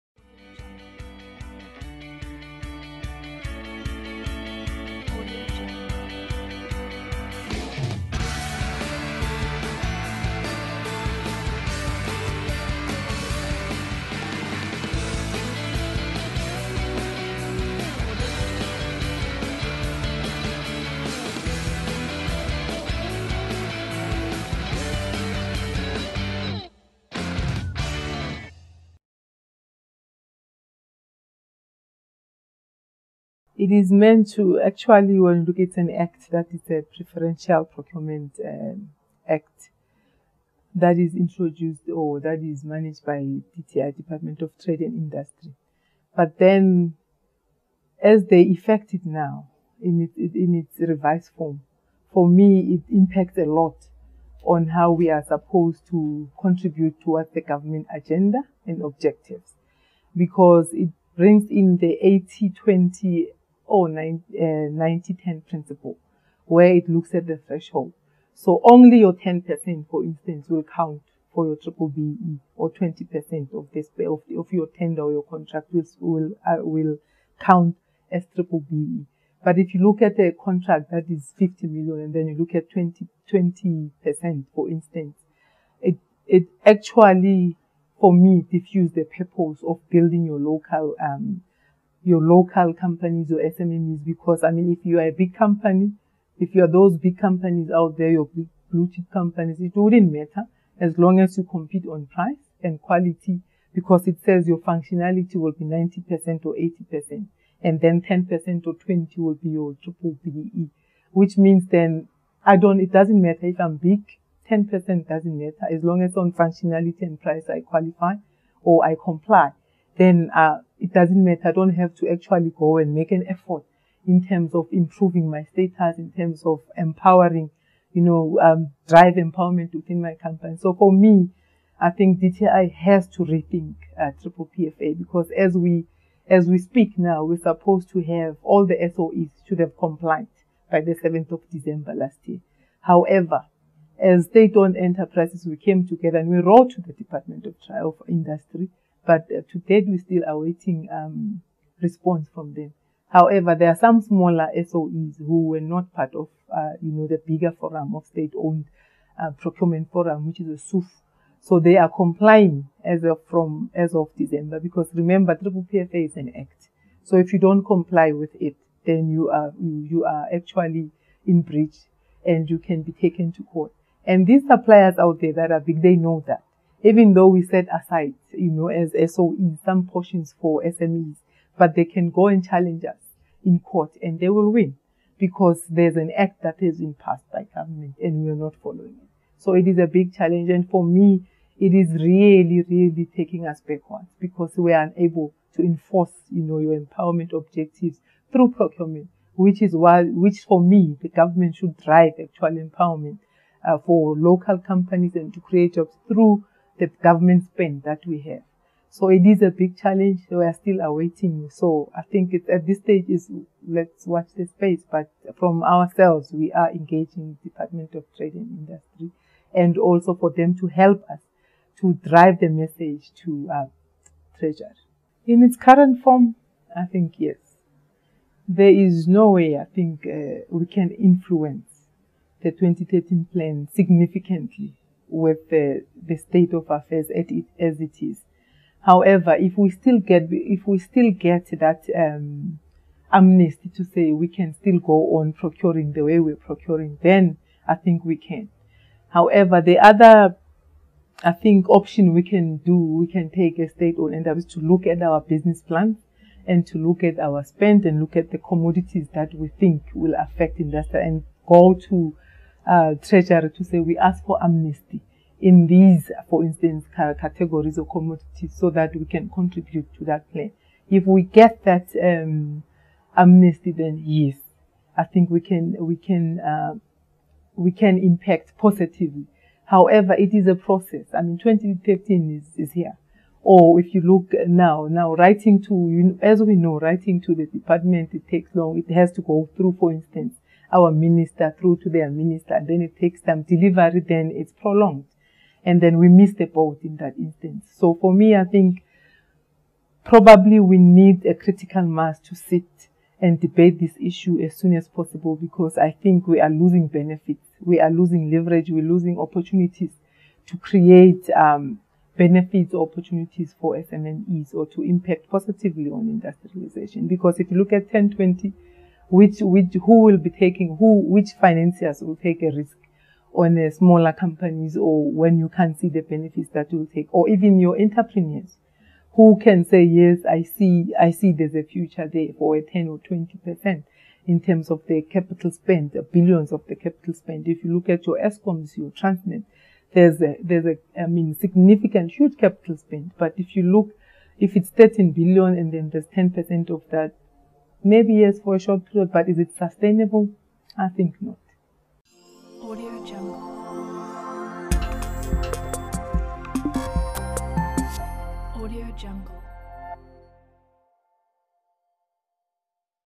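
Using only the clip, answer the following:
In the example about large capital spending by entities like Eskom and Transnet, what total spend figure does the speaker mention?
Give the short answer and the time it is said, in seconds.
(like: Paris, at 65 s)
13 billion, at 344 s.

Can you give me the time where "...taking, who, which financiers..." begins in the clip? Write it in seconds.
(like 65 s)
320 s.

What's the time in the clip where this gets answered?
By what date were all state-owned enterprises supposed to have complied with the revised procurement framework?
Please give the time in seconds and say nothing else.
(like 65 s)
140 s.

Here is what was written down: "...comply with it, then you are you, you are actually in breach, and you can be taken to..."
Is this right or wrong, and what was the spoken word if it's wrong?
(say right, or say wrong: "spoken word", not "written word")
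right.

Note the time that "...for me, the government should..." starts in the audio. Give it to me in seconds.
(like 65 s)
200 s.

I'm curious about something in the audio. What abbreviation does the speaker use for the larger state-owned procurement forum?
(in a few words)
SUF.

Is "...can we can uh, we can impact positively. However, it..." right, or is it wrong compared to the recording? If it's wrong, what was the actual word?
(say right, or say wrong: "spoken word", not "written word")
right.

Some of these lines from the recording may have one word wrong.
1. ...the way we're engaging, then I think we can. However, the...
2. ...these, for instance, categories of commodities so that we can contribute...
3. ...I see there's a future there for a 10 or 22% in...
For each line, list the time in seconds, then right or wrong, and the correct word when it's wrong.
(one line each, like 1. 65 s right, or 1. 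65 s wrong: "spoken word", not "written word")
1. 245 s wrong: "procuring", not "engaging"
2. 265 s right
3. 330 s wrong: "20", not "22".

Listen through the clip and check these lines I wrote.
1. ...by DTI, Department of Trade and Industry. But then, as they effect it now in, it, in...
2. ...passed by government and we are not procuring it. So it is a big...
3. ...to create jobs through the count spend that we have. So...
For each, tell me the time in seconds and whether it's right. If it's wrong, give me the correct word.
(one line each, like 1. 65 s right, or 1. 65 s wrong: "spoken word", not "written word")
1. 43 s right
2. 186 s wrong: "following", not "procuring"
3. 205 s wrong: "government", not "count".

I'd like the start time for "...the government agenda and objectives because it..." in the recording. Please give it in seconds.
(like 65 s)
57 s.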